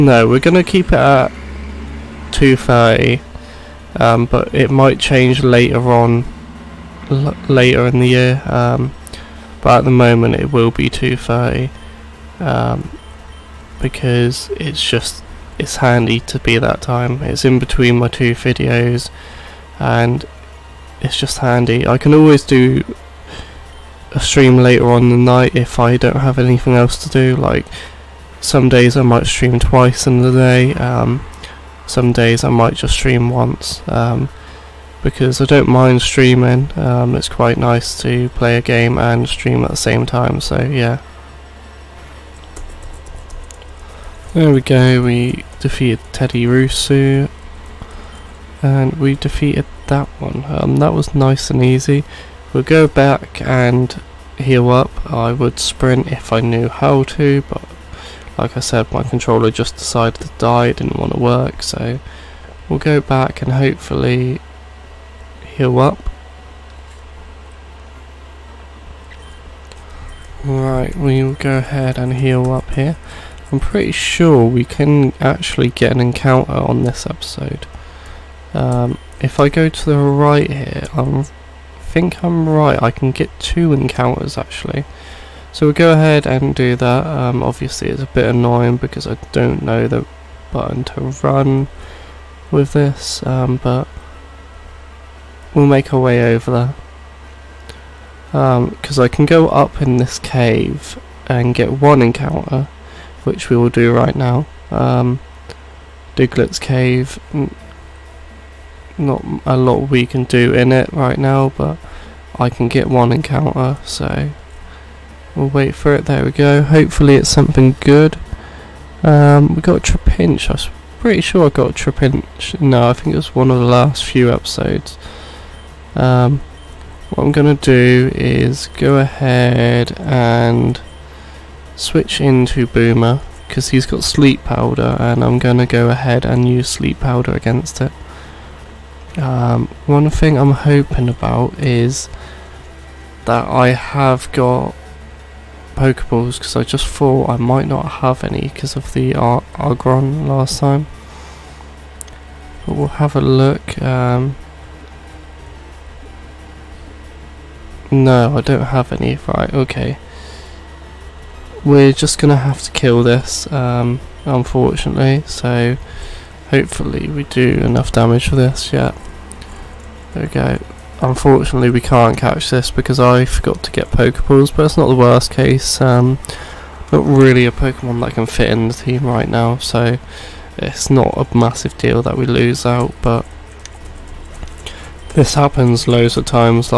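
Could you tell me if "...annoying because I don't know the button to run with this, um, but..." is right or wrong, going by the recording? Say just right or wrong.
right.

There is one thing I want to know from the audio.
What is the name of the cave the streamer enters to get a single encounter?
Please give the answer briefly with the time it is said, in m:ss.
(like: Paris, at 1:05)
Diglett's Cave, at 1:46.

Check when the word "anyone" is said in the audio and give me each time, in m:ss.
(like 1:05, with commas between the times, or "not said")
not said.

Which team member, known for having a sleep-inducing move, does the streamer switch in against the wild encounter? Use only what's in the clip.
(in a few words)
Boomer.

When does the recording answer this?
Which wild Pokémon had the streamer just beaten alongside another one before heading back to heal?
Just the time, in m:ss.
0:46.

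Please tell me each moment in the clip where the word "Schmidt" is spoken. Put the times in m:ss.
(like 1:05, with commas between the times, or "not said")
not said.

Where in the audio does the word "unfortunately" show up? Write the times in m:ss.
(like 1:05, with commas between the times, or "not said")
2:44, 2:51.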